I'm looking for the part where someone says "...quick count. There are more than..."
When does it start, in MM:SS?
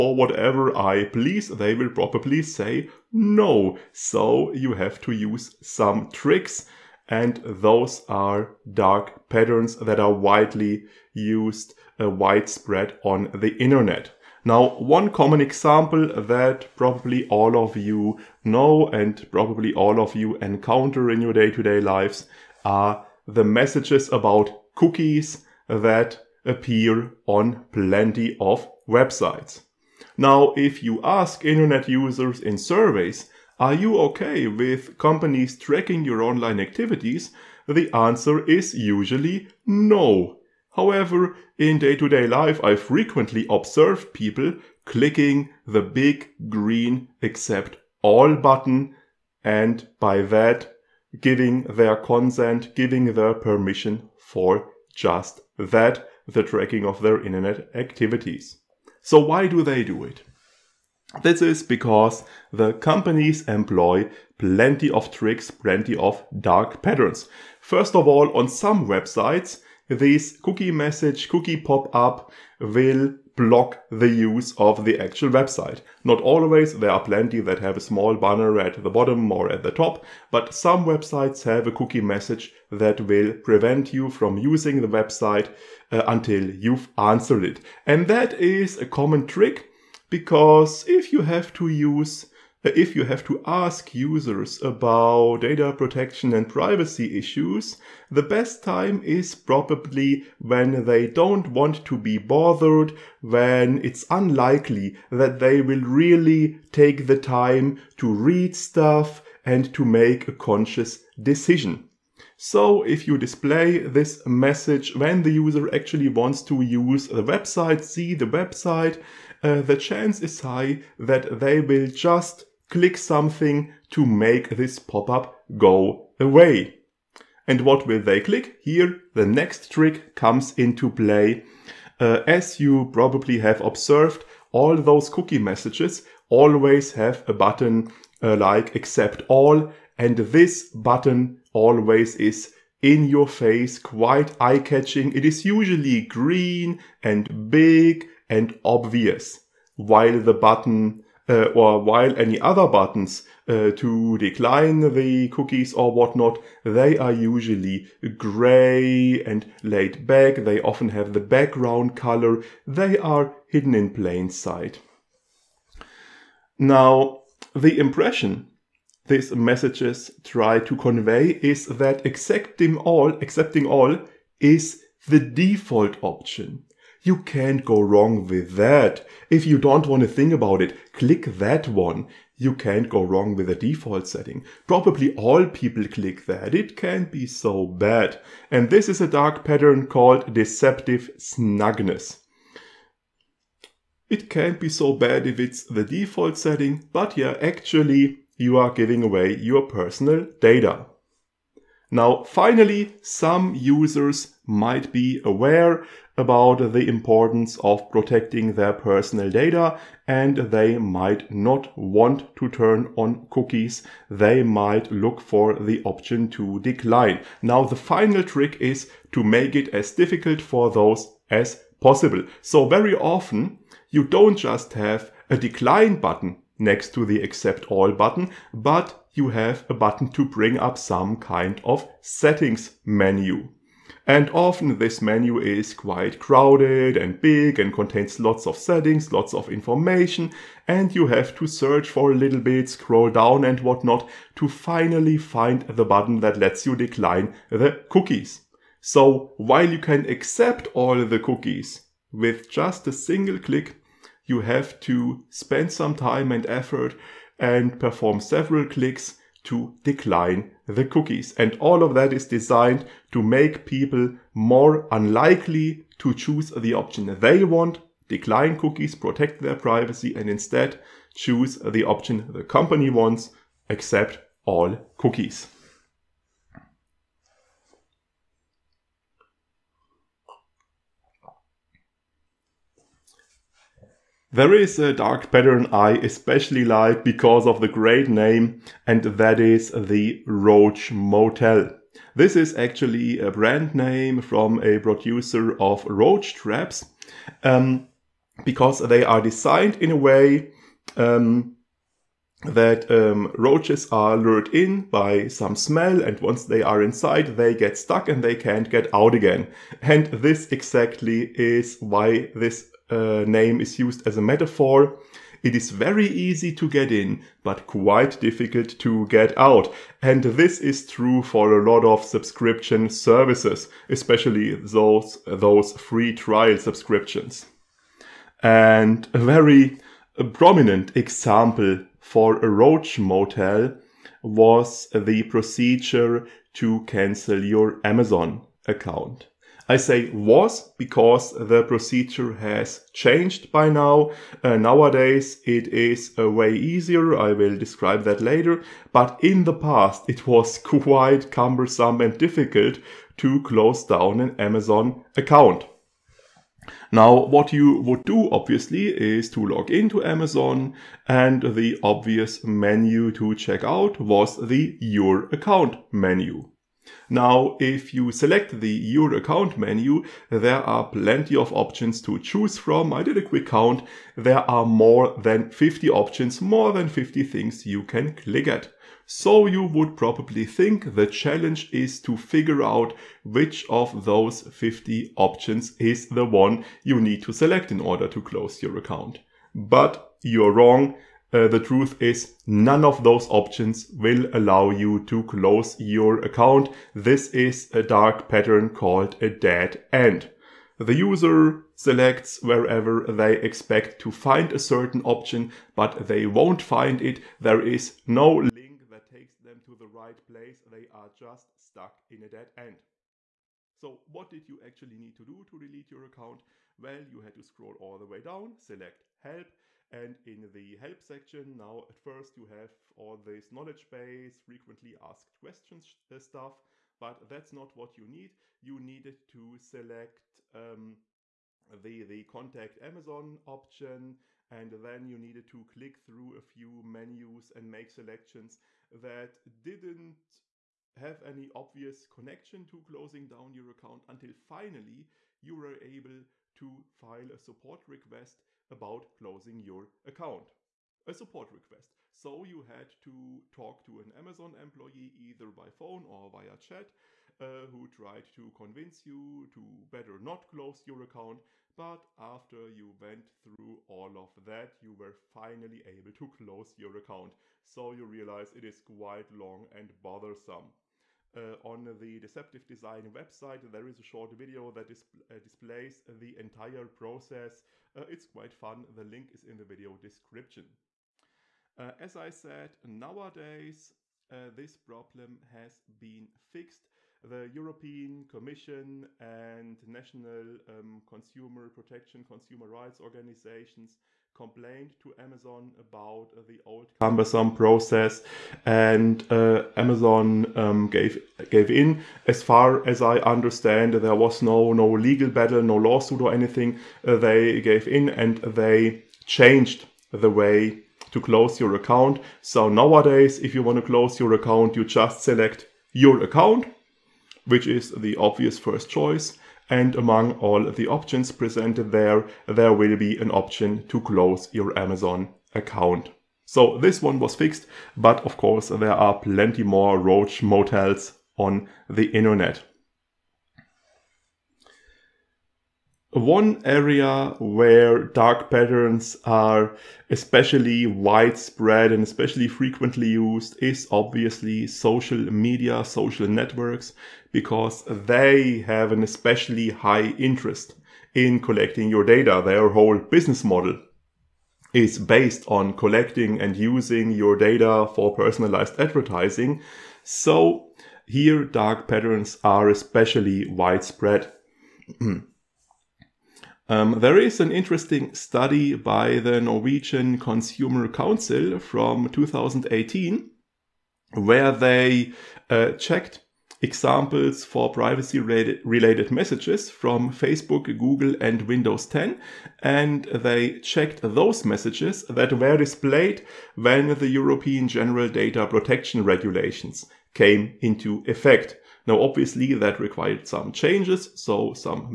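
06:13.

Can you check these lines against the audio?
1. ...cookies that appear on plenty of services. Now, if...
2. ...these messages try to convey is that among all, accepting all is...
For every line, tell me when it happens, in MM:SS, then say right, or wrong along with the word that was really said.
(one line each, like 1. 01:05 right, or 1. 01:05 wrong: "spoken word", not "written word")
1. 00:24 wrong: "websites", not "services"
2. 02:49 wrong: "accepting", not "among".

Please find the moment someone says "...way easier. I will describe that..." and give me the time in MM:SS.
05:46.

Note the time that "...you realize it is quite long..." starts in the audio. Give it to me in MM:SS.
07:47.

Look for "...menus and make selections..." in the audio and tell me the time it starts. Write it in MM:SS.
07:16.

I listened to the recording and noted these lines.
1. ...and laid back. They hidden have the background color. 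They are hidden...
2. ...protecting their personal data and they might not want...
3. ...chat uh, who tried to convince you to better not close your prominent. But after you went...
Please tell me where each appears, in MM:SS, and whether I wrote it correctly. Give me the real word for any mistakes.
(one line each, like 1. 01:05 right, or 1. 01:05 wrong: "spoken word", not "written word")
1. 02:39 wrong: "often", not "hidden"
2. 03:27 right
3. 07:36 wrong: "account", not "prominent".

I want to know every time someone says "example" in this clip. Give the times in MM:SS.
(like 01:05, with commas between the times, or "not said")
00:15, 05:30, 09:36.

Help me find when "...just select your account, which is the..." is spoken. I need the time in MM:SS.
08:34.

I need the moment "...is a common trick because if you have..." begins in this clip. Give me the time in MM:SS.
01:28.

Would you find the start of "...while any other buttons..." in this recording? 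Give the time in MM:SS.
02:31.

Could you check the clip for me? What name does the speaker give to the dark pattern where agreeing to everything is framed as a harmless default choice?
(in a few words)
deceptive snugness.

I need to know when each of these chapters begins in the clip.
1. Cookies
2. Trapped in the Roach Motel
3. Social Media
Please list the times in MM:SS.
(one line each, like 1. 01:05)
1. 00:13
2. 04:43
3. 08:55.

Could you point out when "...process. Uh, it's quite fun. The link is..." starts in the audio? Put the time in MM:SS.
07:56.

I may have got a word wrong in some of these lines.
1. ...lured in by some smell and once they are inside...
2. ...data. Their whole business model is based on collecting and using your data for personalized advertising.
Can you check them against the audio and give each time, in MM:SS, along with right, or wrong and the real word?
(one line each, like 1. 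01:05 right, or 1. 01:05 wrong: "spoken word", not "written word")
1. 05:04 right
2. 09:12 right.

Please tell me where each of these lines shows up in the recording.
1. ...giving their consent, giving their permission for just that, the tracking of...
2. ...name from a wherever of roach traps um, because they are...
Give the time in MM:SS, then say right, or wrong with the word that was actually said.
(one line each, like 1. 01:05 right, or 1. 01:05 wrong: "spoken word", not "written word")
1. 00:51 right
2. 04:53 wrong: "producer", not "wherever".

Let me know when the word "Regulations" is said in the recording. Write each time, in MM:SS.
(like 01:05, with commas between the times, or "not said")
09:49.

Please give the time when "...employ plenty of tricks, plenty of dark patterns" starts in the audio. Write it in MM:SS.
01:03.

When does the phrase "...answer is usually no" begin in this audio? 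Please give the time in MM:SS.
00:37.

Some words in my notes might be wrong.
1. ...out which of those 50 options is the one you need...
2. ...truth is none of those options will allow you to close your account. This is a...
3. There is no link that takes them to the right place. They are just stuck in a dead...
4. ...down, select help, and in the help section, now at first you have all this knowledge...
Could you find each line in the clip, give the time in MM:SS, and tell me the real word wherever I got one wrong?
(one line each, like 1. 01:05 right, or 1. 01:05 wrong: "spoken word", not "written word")
1. 06:22 right
2. 06:31 right
3. 06:47 right
4. 06:58 right.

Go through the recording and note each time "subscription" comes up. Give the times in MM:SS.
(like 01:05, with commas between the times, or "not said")
05:22, 05:26.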